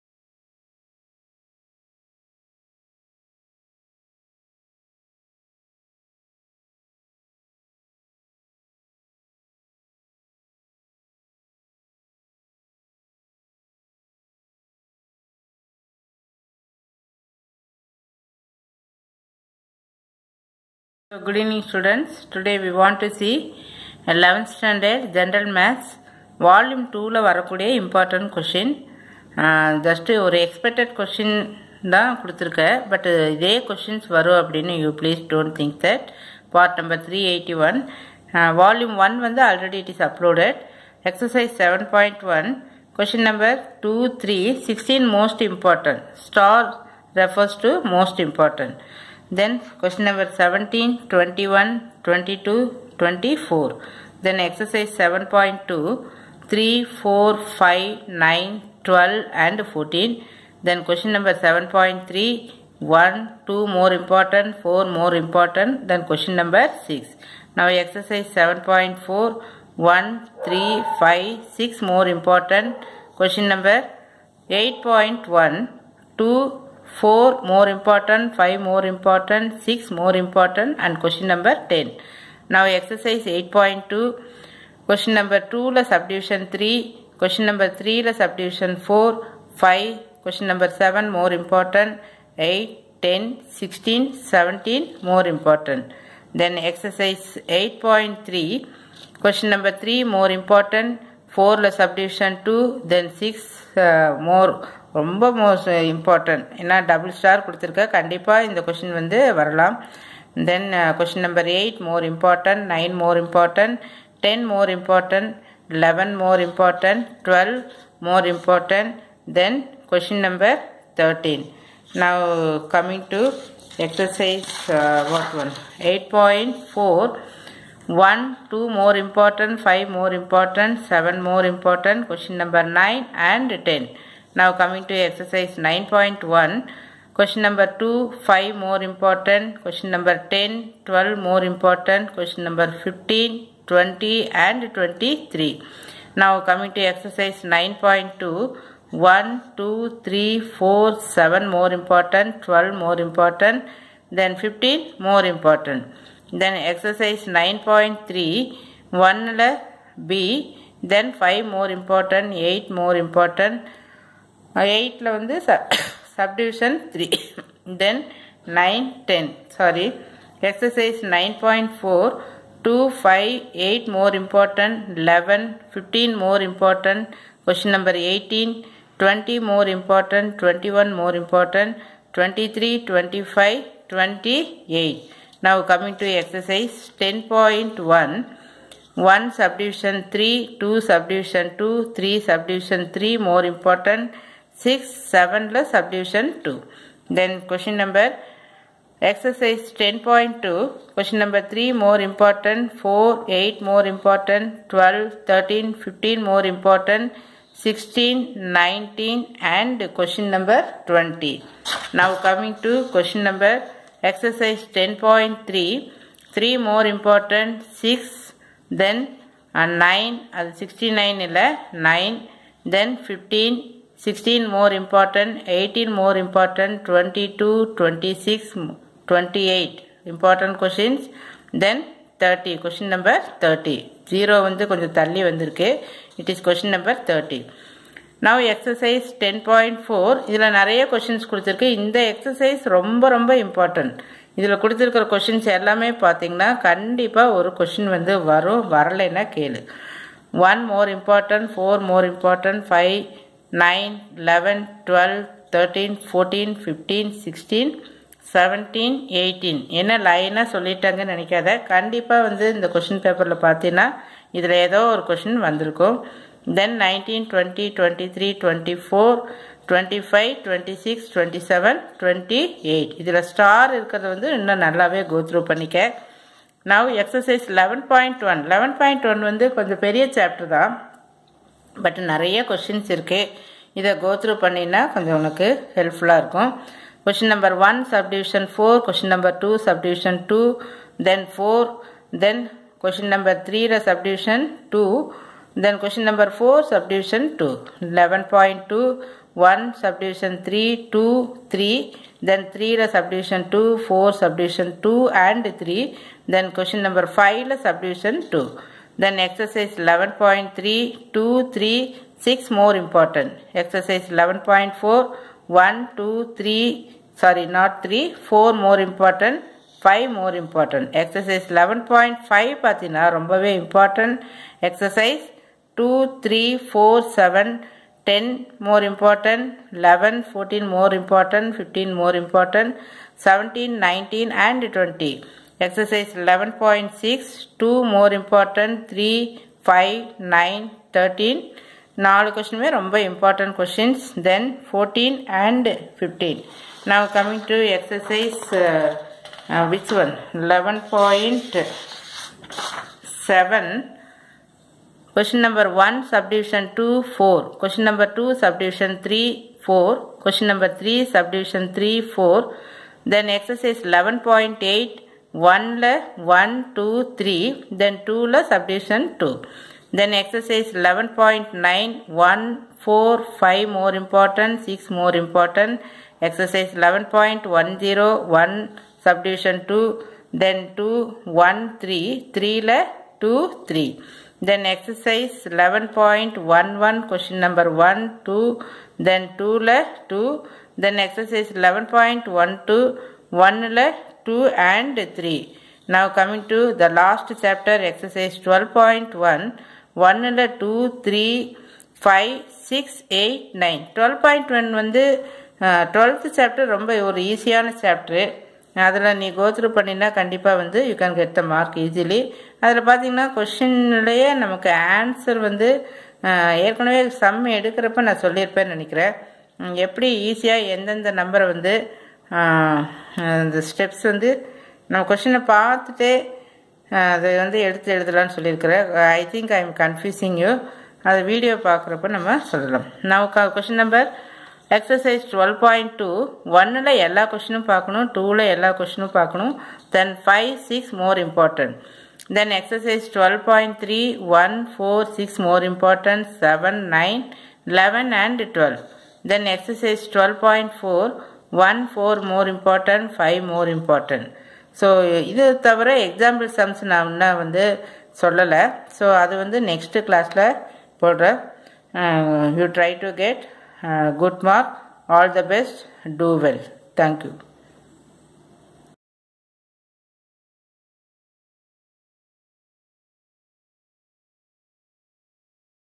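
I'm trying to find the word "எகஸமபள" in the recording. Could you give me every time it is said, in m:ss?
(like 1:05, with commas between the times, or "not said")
7:36.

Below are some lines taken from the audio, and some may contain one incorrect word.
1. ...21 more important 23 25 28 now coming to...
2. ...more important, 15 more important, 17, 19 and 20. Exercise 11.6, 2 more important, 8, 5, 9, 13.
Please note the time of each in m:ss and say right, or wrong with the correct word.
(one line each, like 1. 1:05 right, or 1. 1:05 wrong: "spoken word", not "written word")
1. 3:00 right
2. 5:30 wrong: "3", not "8".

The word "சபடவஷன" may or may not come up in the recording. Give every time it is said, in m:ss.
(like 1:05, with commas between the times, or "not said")
1:41, 4:53.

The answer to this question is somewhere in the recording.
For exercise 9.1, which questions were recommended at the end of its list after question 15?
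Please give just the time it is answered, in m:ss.
2:23.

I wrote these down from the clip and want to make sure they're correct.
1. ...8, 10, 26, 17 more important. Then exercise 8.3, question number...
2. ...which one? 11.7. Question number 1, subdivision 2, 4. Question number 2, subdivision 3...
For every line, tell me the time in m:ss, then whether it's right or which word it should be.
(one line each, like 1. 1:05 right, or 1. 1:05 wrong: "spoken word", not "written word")
1. 1:32 wrong: "16", not "26"
2. 5:49 right.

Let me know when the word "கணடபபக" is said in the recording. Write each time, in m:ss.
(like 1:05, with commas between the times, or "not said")
1:47, 4:06, 4:21, 6:50.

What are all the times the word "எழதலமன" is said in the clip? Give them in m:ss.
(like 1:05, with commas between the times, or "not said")
7:07.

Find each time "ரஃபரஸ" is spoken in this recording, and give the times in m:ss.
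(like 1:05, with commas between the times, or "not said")
0:47.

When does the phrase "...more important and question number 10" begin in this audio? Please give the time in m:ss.
1:19.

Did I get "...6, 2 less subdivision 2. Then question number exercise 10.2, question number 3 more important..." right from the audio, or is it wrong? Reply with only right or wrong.
wrong.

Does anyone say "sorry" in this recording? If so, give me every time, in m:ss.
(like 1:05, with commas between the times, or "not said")
2:49, 5:17.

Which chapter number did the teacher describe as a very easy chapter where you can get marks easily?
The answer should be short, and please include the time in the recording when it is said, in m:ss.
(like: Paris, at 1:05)
12, at 6:45.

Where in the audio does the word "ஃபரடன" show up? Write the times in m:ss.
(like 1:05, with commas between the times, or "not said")
4:16.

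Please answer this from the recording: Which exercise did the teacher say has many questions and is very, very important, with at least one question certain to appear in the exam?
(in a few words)
10.4.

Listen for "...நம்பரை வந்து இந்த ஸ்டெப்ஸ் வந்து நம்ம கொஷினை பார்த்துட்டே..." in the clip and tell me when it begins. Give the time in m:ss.
7:01.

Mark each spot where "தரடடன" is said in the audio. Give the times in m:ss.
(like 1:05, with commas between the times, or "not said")
2:01, 4:15.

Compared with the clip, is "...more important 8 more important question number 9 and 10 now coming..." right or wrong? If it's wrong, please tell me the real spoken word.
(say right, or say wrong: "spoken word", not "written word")
wrong: "7", not "8".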